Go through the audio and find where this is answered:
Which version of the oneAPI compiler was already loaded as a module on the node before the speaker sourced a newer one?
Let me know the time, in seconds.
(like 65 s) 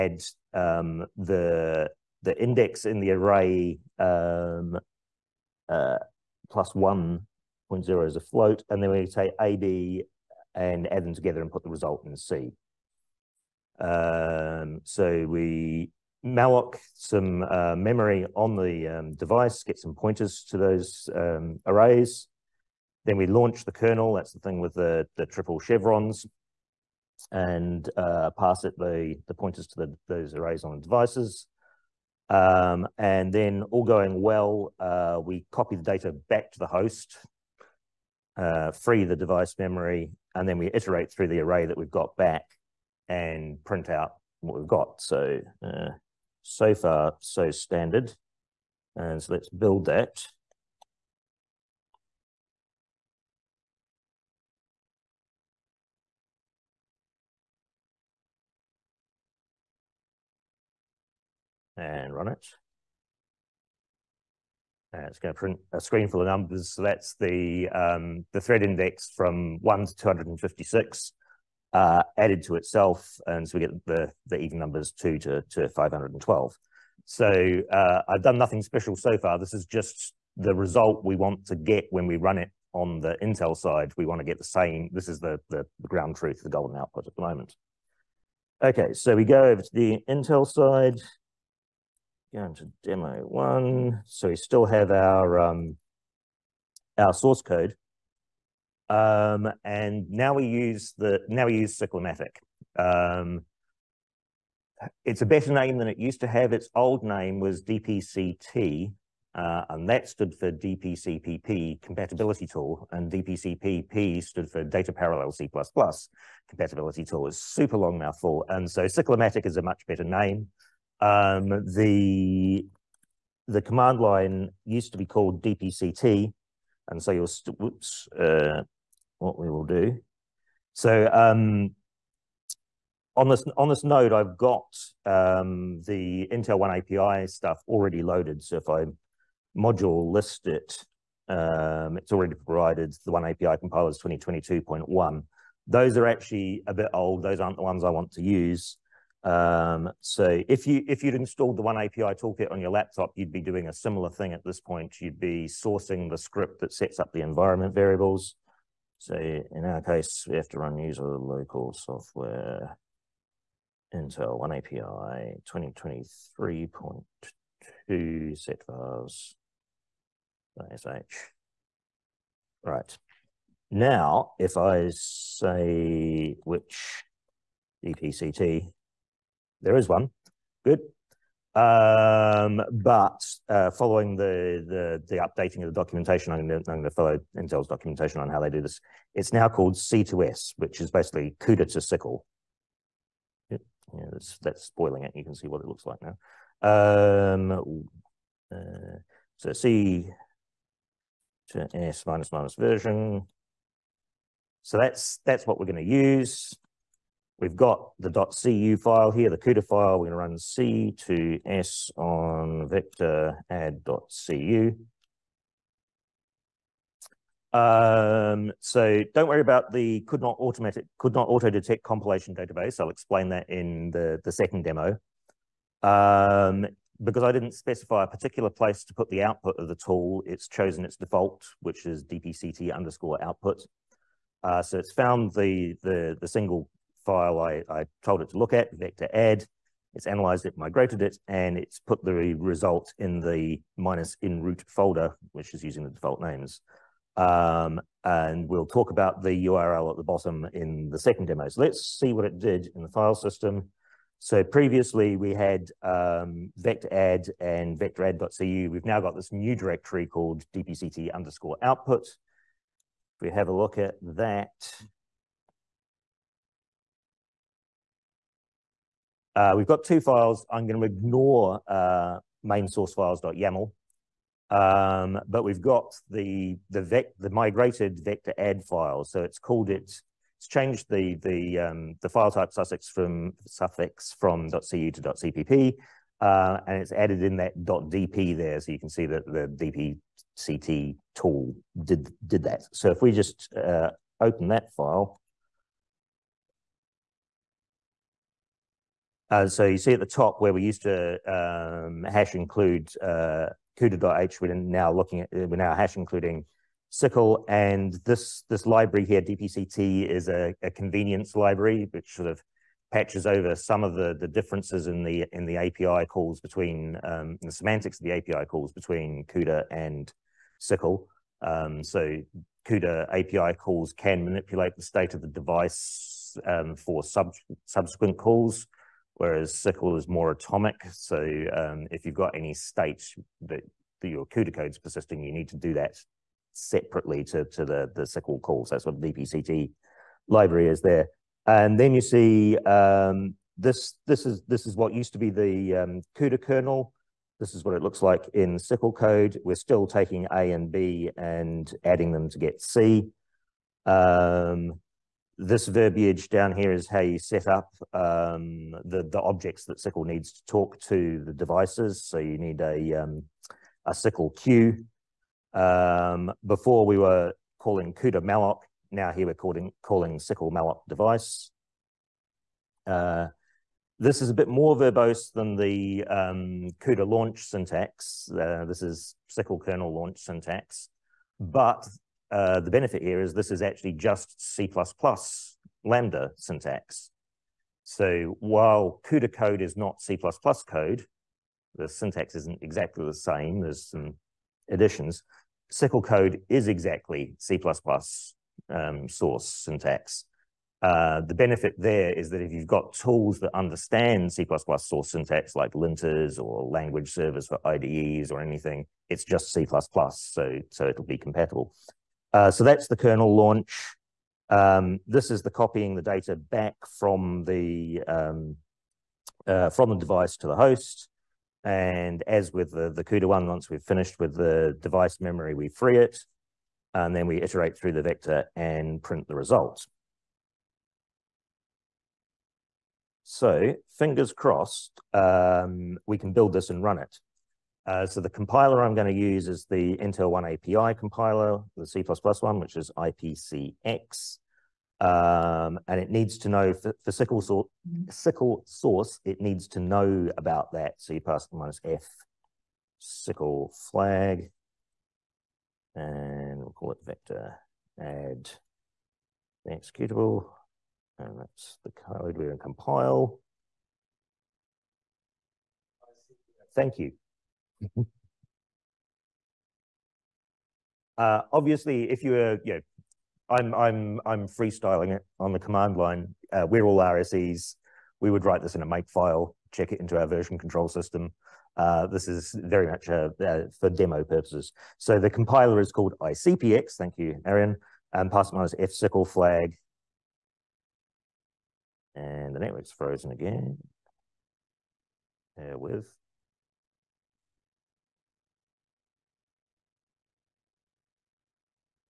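144 s.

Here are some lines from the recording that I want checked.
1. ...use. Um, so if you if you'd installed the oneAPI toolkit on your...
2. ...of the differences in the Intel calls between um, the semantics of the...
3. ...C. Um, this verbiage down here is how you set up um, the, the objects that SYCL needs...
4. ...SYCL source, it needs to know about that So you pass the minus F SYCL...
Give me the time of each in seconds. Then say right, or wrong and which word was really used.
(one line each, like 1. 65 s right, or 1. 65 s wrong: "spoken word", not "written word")
1. 148 s right
2. 313 s wrong: "API", not "Intel"
3. 352 s right
4. 448 s right.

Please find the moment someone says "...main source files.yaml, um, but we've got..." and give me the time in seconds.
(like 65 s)
272 s.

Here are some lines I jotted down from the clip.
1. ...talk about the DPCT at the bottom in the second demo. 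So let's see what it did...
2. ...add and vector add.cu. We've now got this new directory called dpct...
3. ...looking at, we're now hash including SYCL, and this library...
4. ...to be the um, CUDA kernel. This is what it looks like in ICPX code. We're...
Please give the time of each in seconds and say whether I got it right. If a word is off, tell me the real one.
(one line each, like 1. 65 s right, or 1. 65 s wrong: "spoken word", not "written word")
1. 248 s wrong: "URL", not "DPCT"
2. 256 s right
3. 304 s right
4. 345 s wrong: "SYCL", not "ICPX".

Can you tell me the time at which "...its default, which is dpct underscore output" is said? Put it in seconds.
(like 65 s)
230 s.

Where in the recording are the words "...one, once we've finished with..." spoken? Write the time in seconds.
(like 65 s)
423 s.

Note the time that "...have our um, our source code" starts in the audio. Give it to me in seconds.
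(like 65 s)
94 s.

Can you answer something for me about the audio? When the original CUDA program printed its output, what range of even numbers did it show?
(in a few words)
2 to 512.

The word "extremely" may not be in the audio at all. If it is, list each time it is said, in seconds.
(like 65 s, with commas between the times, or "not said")
not said.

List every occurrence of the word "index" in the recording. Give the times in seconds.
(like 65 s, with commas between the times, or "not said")
2 s, 68 s.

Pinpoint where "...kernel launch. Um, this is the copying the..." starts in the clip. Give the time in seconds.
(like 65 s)
412 s.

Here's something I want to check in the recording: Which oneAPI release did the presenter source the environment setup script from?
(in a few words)
2023.2.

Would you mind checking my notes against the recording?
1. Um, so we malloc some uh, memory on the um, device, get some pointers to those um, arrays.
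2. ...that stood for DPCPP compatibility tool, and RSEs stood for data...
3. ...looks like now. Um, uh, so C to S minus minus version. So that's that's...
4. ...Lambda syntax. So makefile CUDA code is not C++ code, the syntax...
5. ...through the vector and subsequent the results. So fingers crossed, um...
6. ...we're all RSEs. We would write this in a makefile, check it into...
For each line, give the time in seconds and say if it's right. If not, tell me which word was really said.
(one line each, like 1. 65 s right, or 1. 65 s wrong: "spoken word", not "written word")
1. 13 s right
2. 109 s wrong: "DPCPP", not "RSEs"
3. 195 s right
4. 385 s wrong: "while", not "makefile"
5. 427 s wrong: "print", not "subsequent"
6. 476 s right.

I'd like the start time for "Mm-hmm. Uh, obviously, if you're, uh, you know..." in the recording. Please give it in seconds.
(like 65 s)
467 s.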